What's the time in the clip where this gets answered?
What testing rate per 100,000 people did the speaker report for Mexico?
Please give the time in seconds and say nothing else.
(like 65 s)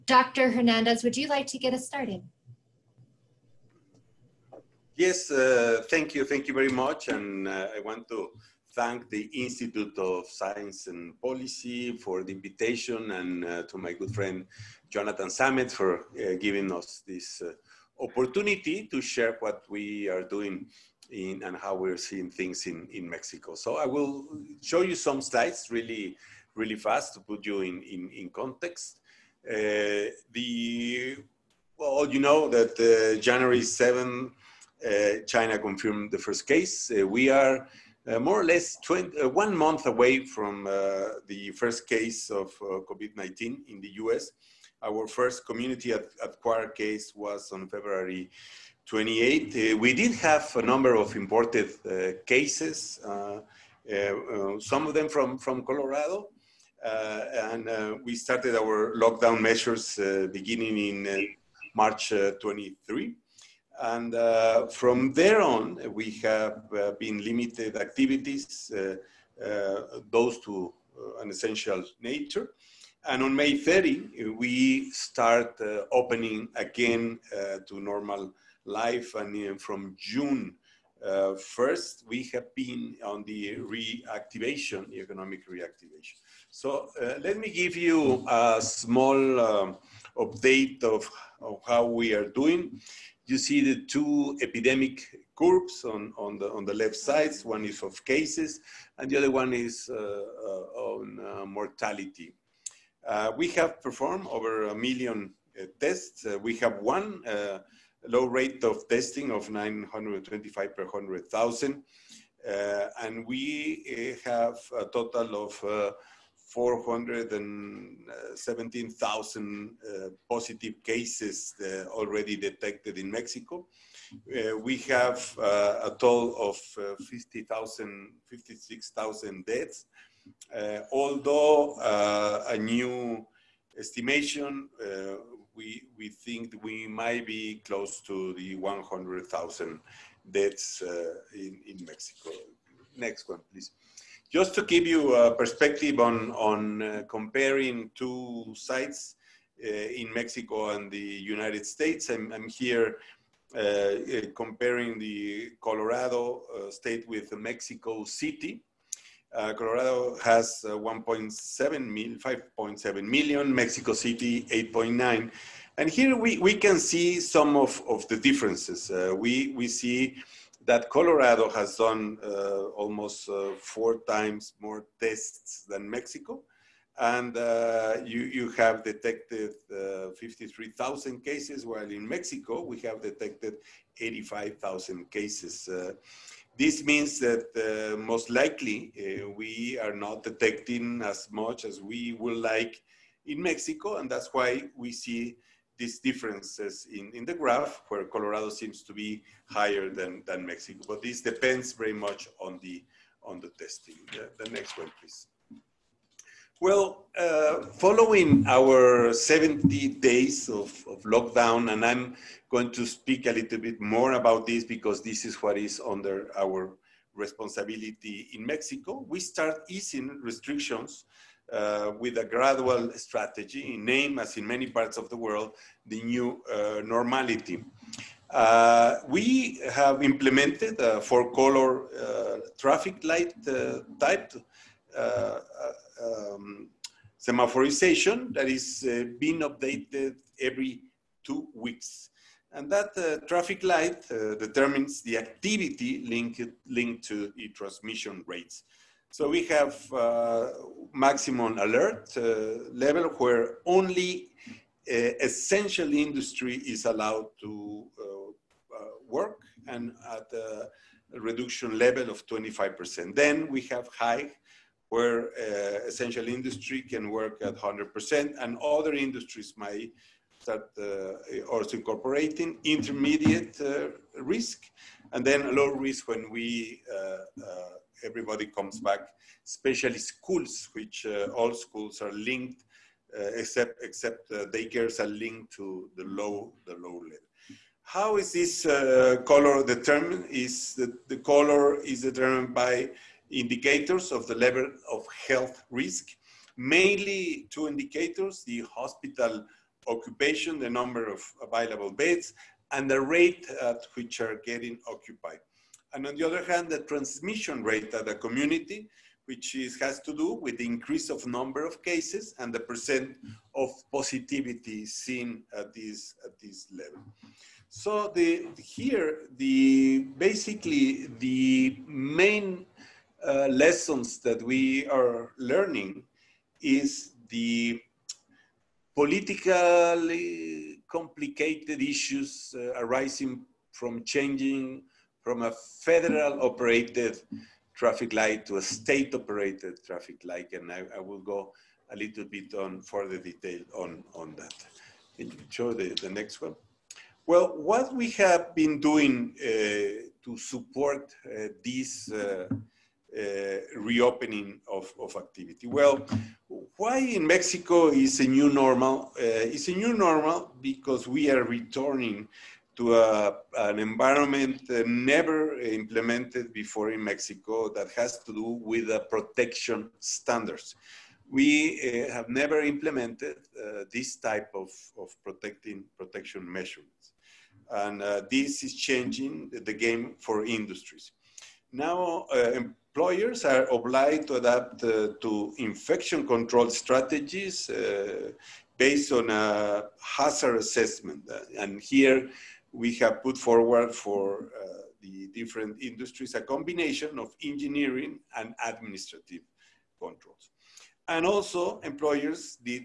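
109 s.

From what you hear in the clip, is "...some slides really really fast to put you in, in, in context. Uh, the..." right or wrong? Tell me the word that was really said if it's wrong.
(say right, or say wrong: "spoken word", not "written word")
right.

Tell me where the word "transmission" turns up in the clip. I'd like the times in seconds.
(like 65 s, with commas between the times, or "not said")
247 s, 306 s.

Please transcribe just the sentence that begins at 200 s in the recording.
But this depends very much on the, on the testing.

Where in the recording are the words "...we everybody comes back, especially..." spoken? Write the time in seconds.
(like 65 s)
276 s.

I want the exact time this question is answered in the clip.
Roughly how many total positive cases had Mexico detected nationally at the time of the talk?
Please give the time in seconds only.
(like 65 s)
116 s.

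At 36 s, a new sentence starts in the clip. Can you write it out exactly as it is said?
Uh, we are more or less 20, one month away from the first case of COVID-19 in the US.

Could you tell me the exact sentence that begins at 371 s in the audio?
We uh, have never implemented uh, this type of, of protecting protection measures, And uh, this is changing the game for industries.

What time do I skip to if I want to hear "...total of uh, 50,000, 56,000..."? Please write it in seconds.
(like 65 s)
125 s.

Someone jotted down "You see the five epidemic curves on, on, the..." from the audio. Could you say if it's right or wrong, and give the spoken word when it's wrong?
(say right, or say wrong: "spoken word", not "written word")
wrong: "two", not "five".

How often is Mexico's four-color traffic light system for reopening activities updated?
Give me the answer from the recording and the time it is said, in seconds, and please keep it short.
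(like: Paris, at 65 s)
every two weeks, at 240 s.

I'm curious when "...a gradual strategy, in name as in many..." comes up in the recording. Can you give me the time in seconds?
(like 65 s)
222 s.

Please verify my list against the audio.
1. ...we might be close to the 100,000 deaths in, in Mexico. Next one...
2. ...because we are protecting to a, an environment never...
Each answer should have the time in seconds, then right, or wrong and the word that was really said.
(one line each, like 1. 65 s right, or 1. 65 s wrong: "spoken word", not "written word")
1. 136 s right
2. 360 s wrong: "returning", not "protecting".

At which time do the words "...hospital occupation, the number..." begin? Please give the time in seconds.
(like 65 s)
298 s.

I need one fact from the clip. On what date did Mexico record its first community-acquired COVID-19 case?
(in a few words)
February 28.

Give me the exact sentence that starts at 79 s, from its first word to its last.
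And uh, from June 1st, we have been on the reactivation, the economic reactivation.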